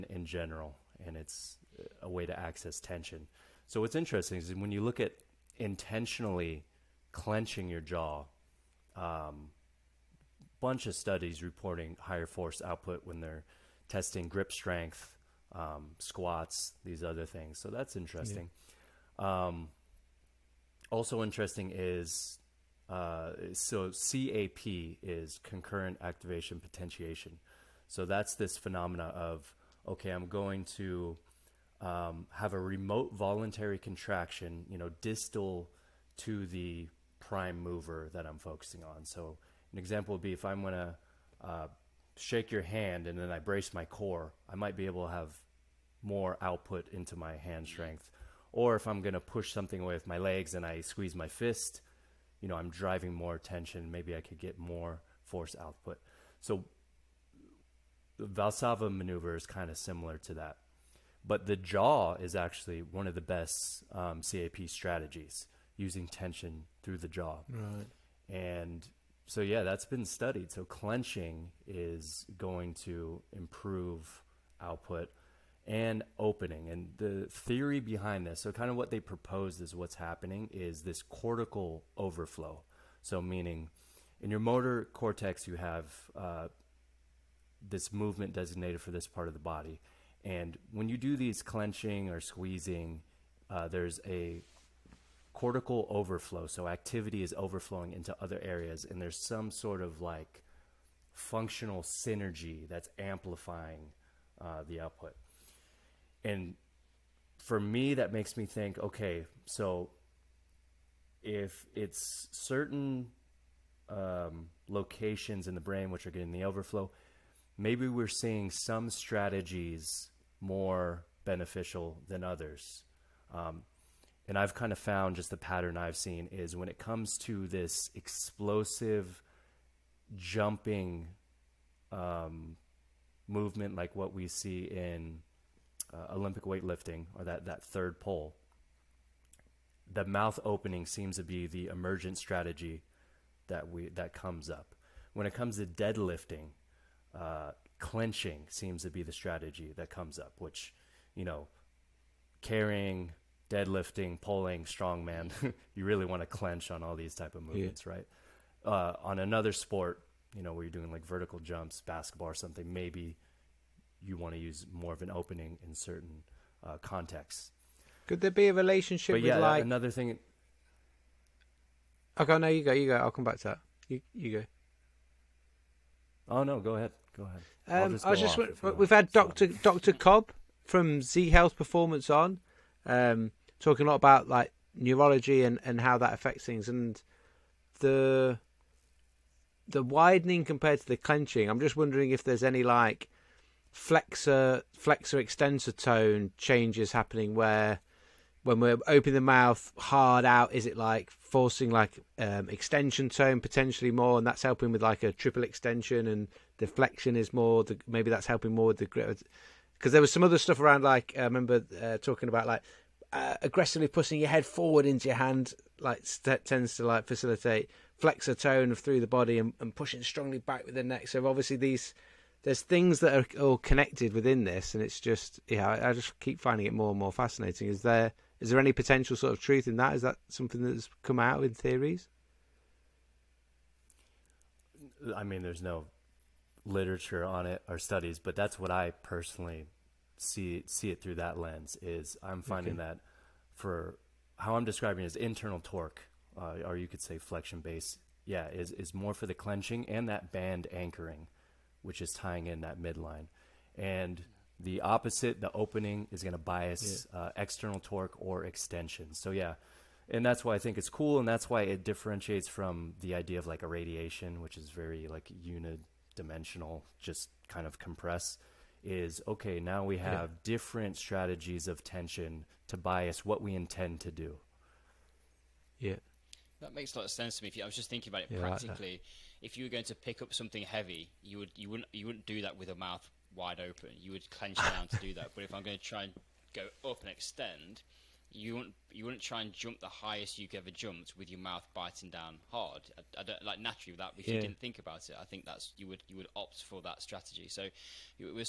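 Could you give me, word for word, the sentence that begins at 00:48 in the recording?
Or if I'm going to push something away with my legs and I squeeze my fist, you know, I'm driving more attention.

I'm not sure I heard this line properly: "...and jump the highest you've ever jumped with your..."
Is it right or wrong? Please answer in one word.
right.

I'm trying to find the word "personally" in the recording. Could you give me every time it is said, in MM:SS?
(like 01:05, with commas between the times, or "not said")
03:59.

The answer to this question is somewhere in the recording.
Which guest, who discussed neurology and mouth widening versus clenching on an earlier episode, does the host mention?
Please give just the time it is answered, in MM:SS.
02:59.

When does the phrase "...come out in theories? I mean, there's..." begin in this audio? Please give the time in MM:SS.
03:51.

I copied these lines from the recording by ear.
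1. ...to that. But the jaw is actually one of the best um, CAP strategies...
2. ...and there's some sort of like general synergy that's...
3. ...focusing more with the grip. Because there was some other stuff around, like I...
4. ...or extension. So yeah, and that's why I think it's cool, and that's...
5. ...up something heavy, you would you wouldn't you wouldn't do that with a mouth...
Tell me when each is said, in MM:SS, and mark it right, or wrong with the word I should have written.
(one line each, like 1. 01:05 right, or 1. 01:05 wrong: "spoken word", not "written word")
1. 01:00 right
2. 01:38 wrong: "functional", not "general"
3. 03:28 wrong: "helping", not "focusing"
4. 04:18 right
5. 04:40 right.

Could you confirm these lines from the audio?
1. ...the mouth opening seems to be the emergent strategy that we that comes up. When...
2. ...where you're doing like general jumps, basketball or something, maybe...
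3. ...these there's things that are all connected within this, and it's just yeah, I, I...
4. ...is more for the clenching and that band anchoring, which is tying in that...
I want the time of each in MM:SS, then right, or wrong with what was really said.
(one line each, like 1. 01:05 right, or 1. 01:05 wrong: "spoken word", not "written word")
1. 02:19 right
2. 02:40 wrong: "vertical", not "general"
3. 03:41 right
4. 04:08 right.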